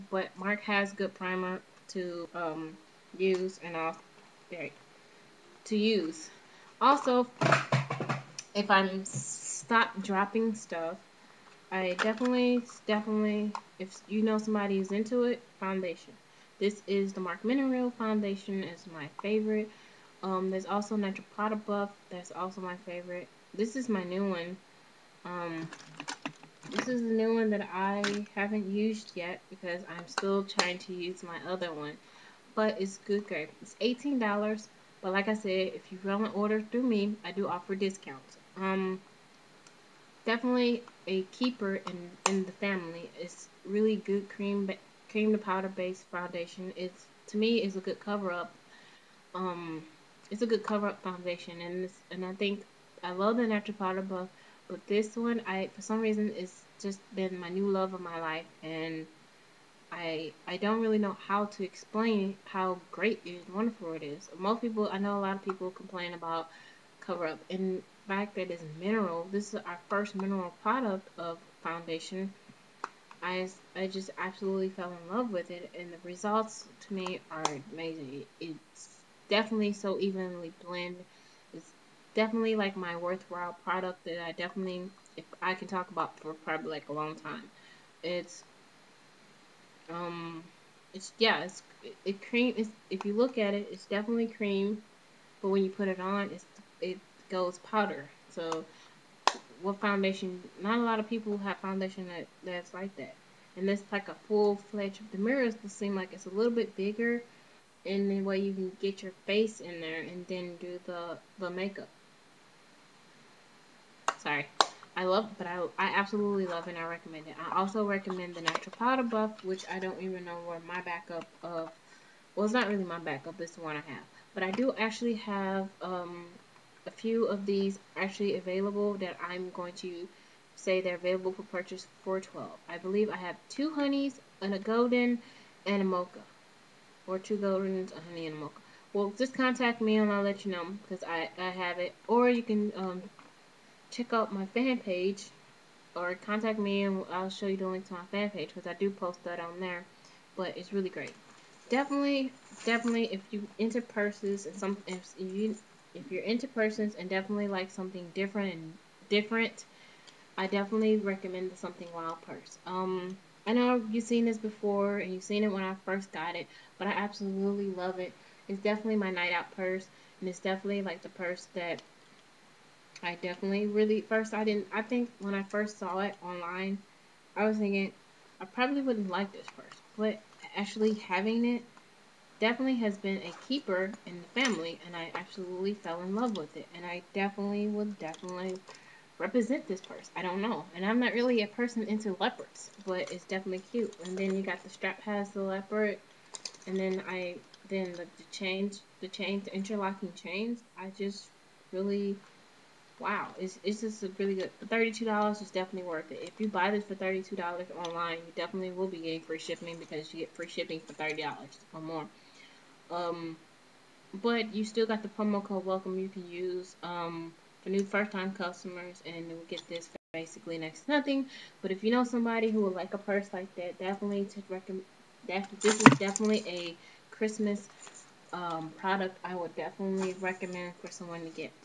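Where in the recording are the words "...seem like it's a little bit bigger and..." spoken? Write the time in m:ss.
1:45.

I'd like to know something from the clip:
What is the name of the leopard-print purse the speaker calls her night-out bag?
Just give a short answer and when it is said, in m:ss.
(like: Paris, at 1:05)
Something Wild, at 2:41.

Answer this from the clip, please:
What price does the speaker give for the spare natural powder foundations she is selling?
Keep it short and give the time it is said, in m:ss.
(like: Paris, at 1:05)
12, at 2:12.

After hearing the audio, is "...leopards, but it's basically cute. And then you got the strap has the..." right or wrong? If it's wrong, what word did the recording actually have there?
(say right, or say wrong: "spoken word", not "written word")
wrong: "definitely", not "basically".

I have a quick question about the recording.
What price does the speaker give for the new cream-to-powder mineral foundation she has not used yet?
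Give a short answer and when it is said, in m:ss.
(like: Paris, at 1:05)
$18, at 0:33.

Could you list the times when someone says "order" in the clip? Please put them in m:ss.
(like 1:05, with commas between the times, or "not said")
0:36.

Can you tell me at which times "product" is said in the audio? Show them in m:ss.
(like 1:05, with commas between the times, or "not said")
1:10, 1:23, 3:48.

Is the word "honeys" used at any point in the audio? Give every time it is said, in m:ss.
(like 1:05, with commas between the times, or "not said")
2:13, 2:18.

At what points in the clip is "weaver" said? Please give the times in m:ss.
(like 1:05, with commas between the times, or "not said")
not said.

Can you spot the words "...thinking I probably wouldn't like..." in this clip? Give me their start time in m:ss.
2:57.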